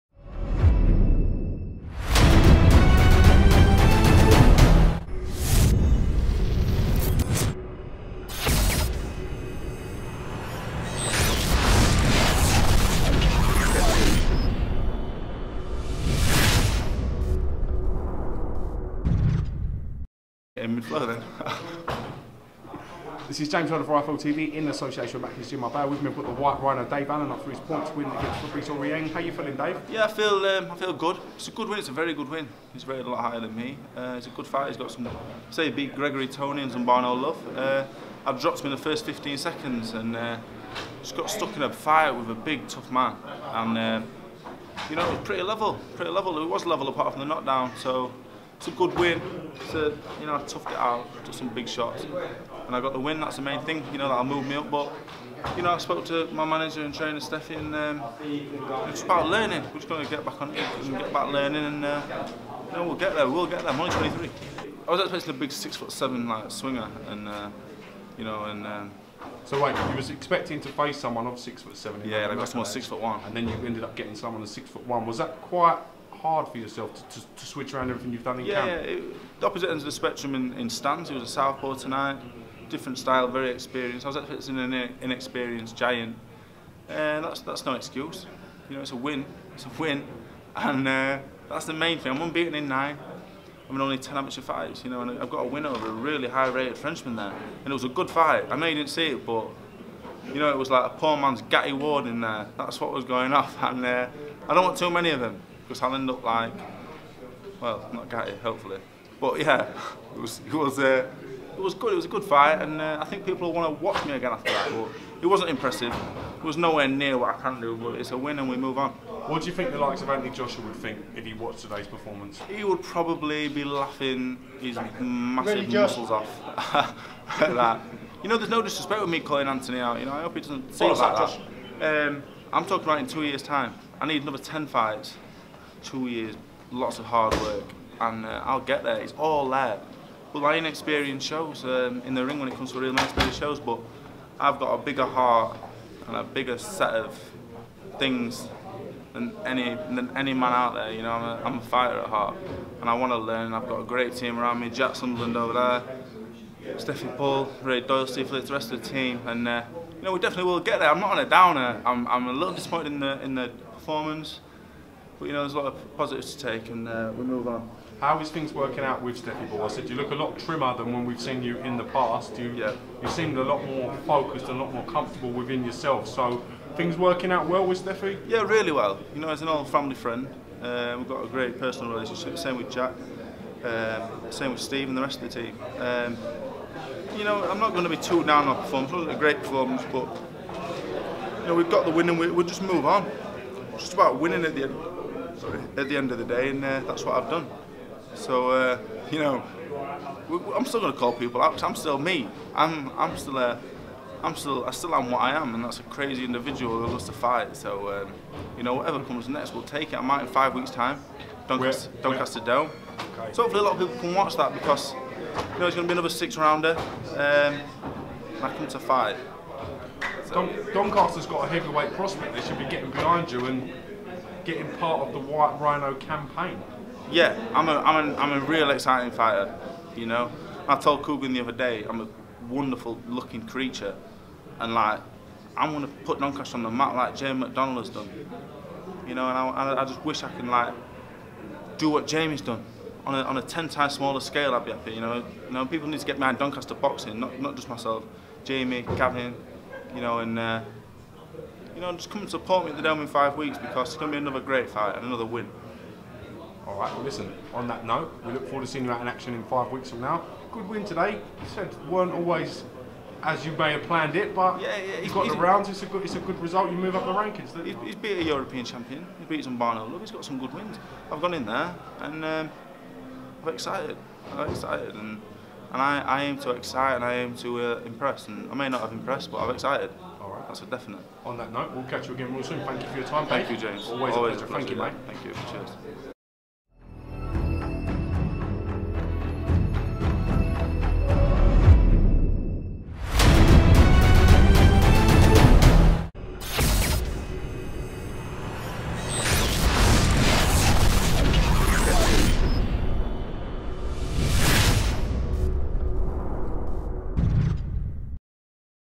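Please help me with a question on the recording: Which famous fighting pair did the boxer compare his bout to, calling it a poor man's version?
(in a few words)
Gatti Ward.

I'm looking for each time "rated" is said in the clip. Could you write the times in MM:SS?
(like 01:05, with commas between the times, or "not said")
00:32, 01:36.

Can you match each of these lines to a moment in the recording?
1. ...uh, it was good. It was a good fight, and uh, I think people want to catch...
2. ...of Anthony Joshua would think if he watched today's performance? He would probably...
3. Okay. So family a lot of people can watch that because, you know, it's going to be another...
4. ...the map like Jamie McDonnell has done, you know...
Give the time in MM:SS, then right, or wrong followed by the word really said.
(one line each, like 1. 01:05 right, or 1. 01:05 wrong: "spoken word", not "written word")
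1. 01:50 wrong: "watch", not "catch"
2. 02:00 right
3. 03:33 wrong: "hopefully", not "family"
4. 03:56 right.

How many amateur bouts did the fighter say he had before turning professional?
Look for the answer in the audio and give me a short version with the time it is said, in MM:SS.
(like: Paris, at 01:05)
10, at 01:33.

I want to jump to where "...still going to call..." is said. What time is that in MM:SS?
03:20.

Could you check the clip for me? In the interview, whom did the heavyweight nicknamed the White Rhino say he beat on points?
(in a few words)
Fabrice Aurieng.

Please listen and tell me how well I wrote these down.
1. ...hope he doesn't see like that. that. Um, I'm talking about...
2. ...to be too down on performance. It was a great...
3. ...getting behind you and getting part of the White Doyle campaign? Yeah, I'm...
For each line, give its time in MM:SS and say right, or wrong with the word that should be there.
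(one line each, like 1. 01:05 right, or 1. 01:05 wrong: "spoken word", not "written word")
1. 02:10 right
2. 03:07 right
3. 03:42 wrong: "Rhino", not "Doyle".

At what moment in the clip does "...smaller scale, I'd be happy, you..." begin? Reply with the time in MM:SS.
04:03.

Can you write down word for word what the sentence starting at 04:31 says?
I've gone in there and um, I'm excited.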